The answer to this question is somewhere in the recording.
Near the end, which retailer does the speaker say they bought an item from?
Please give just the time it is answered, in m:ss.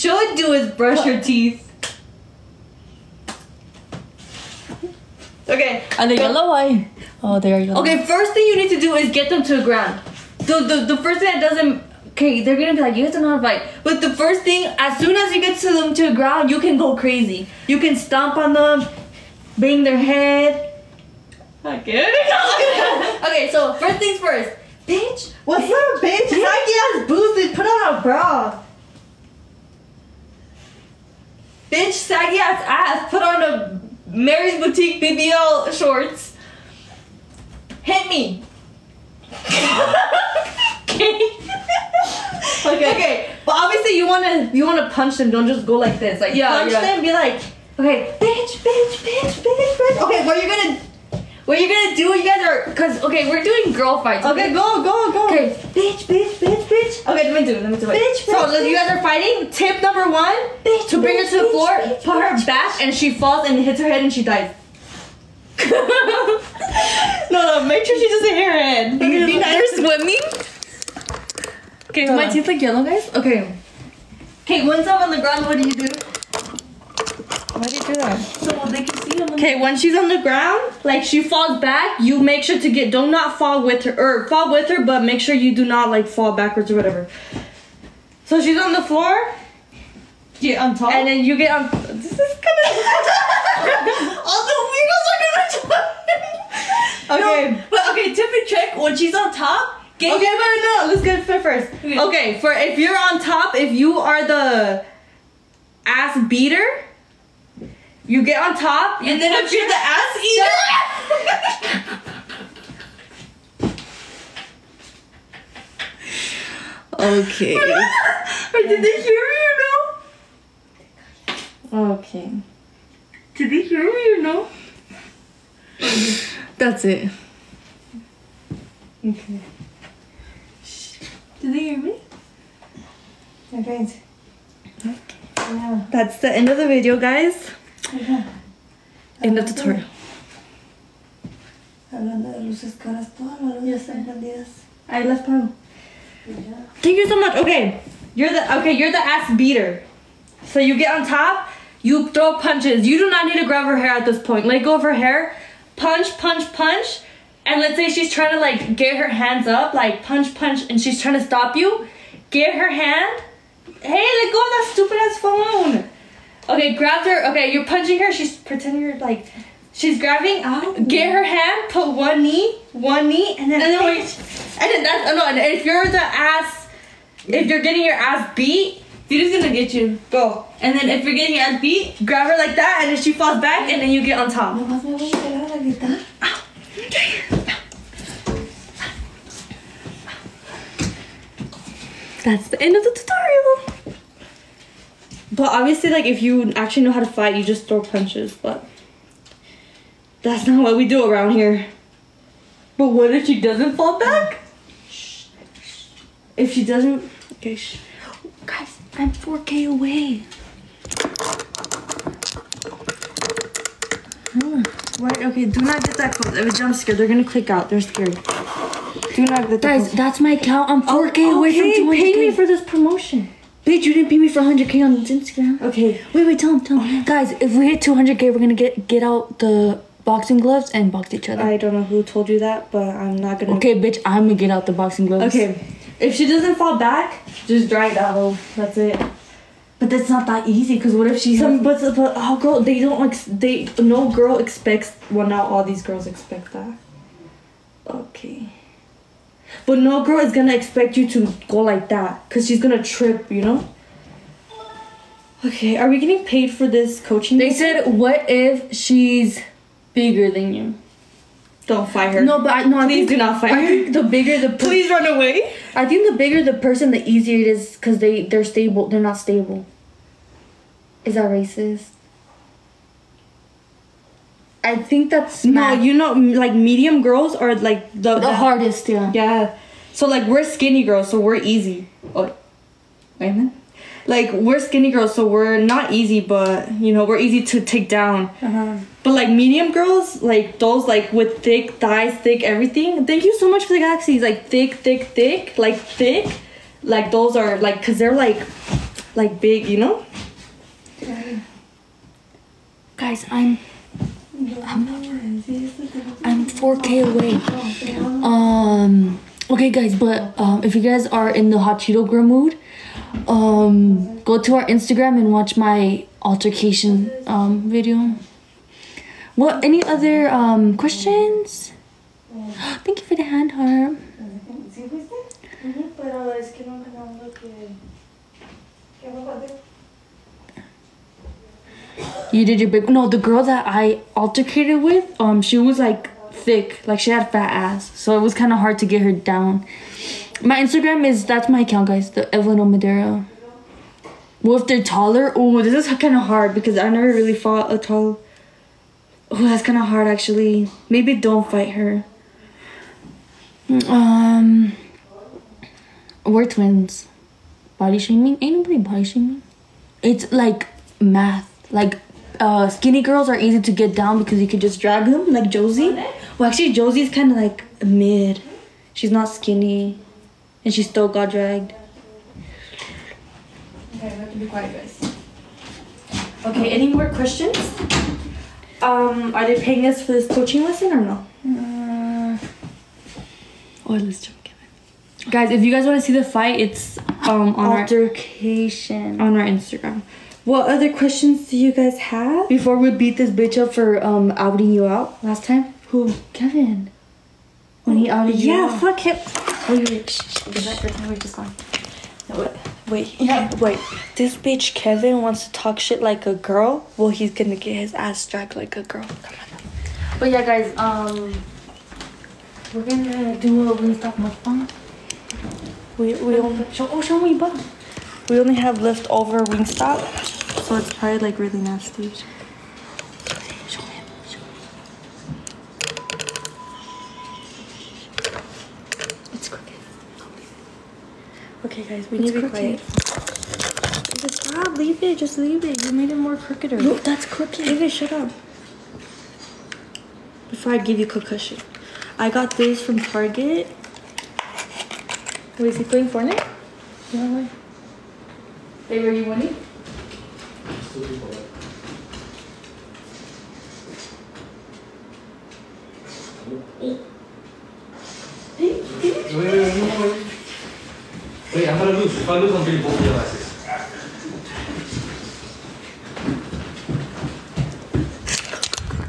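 7:22.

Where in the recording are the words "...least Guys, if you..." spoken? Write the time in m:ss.
6:24.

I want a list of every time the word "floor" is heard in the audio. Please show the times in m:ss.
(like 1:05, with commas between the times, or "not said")
1:01, 1:28.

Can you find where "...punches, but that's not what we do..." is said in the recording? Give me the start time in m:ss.
3:17.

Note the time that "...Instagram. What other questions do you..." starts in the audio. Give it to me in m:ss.
6:29.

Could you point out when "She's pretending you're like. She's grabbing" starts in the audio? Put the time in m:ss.
2:48.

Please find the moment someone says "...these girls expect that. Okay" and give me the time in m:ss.
4:05.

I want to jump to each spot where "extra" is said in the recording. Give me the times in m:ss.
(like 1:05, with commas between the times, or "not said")
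not said.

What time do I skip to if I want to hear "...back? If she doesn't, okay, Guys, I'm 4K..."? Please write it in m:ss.
3:23.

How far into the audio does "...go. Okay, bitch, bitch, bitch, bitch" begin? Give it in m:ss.
0:55.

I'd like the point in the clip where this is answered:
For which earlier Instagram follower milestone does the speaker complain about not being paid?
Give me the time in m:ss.
3:44.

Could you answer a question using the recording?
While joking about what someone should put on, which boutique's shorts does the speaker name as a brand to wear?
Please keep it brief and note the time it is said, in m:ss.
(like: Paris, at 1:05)
Mary's Boutique, at 0:34.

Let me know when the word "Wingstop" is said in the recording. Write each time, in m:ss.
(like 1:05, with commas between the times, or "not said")
6:53, 6:59.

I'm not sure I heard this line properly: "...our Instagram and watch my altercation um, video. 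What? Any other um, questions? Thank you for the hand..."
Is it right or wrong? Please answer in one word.
right.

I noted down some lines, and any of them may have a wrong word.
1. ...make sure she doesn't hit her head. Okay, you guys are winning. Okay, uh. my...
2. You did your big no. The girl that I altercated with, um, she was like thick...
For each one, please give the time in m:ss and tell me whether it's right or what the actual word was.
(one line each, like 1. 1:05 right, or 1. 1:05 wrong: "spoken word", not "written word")
1. 1:07 wrong: "swimming", not "winning"
2. 5:32 right.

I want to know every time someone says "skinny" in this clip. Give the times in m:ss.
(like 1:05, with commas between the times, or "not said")
4:40, 4:44, 6:02, 6:09.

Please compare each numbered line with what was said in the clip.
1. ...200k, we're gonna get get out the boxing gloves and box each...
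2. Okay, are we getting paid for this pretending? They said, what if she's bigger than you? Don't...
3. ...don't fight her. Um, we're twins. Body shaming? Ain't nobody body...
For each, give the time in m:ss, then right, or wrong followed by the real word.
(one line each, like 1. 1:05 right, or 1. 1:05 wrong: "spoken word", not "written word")
1. 3:47 right
2. 4:15 wrong: "coaching", not "pretending"
3. 5:51 right.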